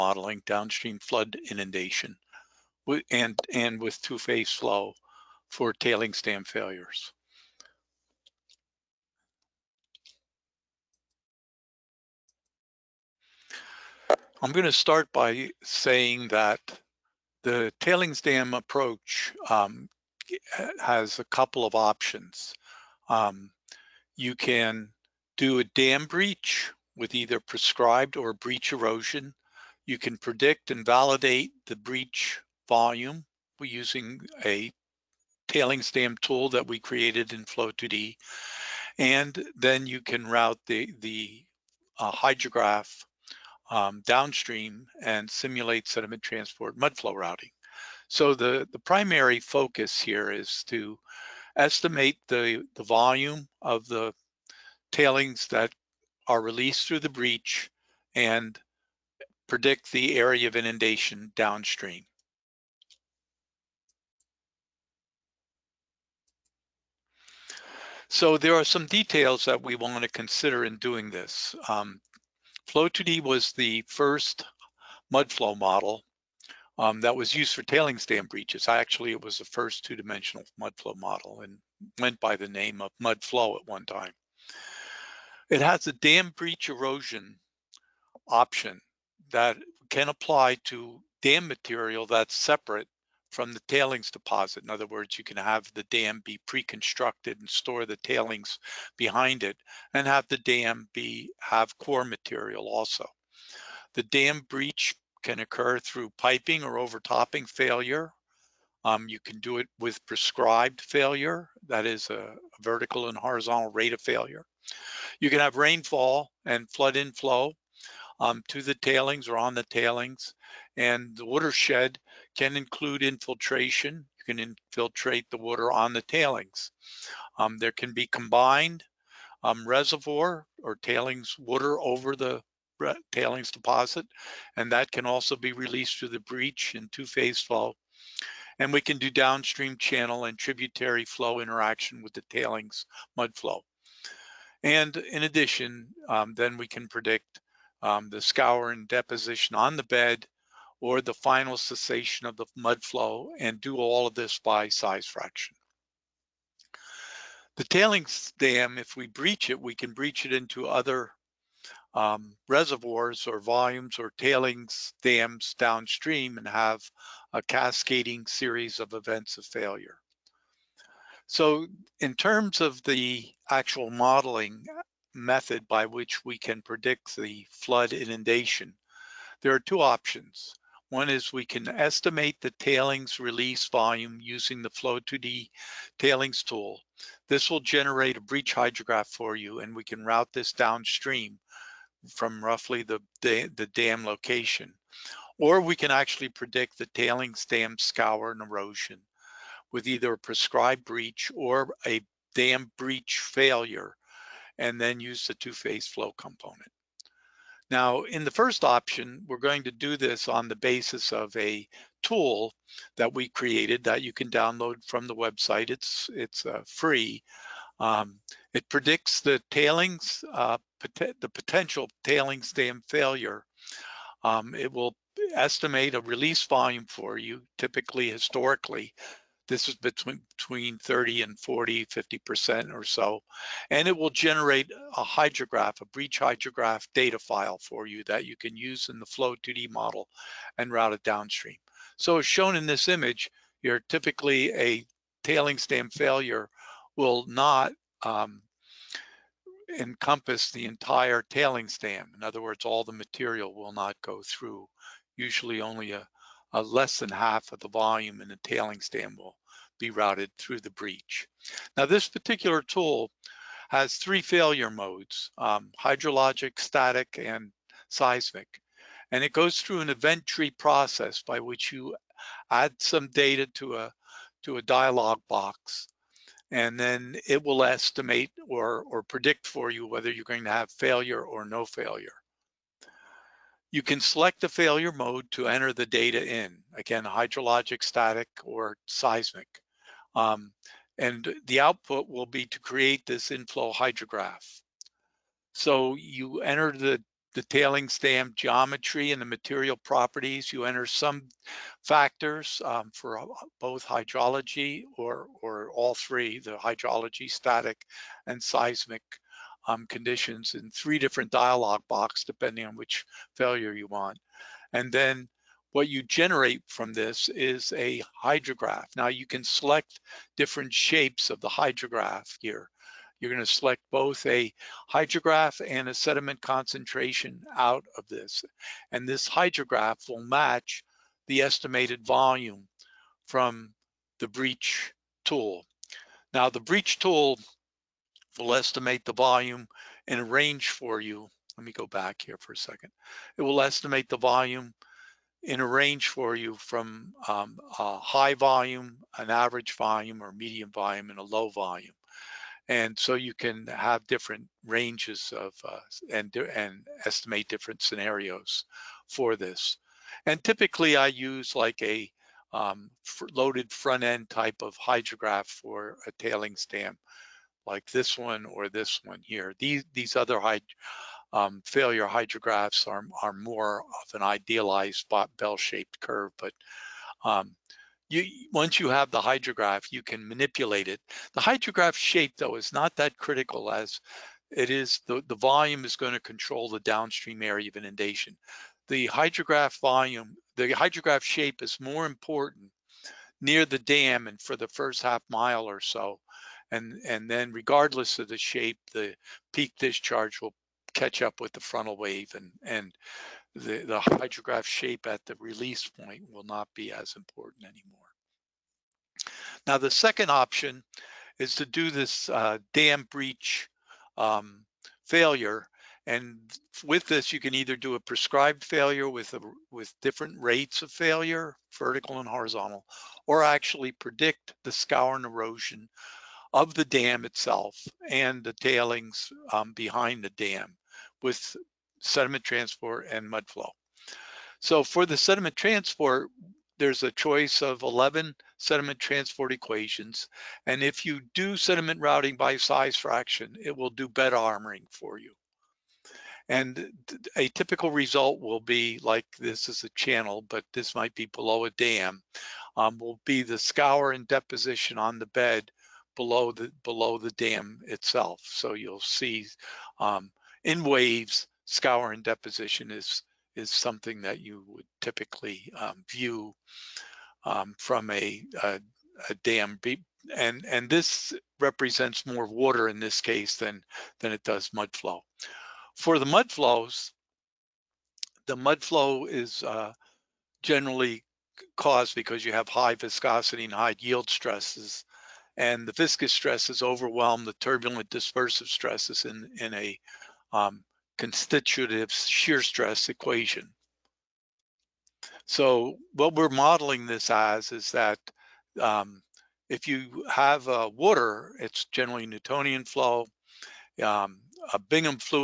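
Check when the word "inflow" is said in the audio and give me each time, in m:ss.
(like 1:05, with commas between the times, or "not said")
1:56, 4:53.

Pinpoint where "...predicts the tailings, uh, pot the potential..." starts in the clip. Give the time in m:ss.
3:38.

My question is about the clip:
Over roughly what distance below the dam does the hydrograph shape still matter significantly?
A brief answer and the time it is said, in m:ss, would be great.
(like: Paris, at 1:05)
First half mile, at 6:34.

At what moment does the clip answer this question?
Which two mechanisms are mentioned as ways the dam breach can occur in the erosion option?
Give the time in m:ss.
1:46.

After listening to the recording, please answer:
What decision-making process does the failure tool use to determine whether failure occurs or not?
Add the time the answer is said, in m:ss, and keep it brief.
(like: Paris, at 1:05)
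Event tree, at 4:29.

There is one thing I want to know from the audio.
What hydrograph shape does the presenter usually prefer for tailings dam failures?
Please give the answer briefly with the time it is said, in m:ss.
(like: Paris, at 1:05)
Loaded front end, at 6:03.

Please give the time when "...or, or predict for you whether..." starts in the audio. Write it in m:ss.
4:38.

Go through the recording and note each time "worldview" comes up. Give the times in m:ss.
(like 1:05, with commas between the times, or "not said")
not said.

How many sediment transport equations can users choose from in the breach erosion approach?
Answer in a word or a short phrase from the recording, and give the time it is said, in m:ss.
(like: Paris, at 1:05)
11, at 7:17.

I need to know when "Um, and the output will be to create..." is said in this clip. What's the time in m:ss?
4:50.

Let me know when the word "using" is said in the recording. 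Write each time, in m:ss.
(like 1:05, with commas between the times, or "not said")
0:33, 3:04.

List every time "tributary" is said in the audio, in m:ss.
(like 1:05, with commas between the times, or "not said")
2:20.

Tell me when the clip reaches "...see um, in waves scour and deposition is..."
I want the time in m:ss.
7:38.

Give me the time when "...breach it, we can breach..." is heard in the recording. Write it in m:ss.
2:39.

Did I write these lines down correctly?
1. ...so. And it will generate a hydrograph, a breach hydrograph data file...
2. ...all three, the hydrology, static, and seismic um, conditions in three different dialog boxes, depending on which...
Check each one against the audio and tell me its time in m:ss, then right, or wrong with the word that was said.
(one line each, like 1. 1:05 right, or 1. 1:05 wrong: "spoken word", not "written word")
1. 3:52 right
2. 5:05 right.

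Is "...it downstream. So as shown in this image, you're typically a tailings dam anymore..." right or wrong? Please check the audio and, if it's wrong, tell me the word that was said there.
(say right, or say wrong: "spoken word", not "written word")
wrong: "failure", not "anymore".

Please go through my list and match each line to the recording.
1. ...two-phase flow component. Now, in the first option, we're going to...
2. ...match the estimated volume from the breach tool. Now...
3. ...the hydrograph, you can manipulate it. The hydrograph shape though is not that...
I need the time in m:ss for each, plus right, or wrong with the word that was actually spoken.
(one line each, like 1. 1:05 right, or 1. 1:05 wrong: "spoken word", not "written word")
1. 3:25 right
2. 5:30 right
3. 6:19 right.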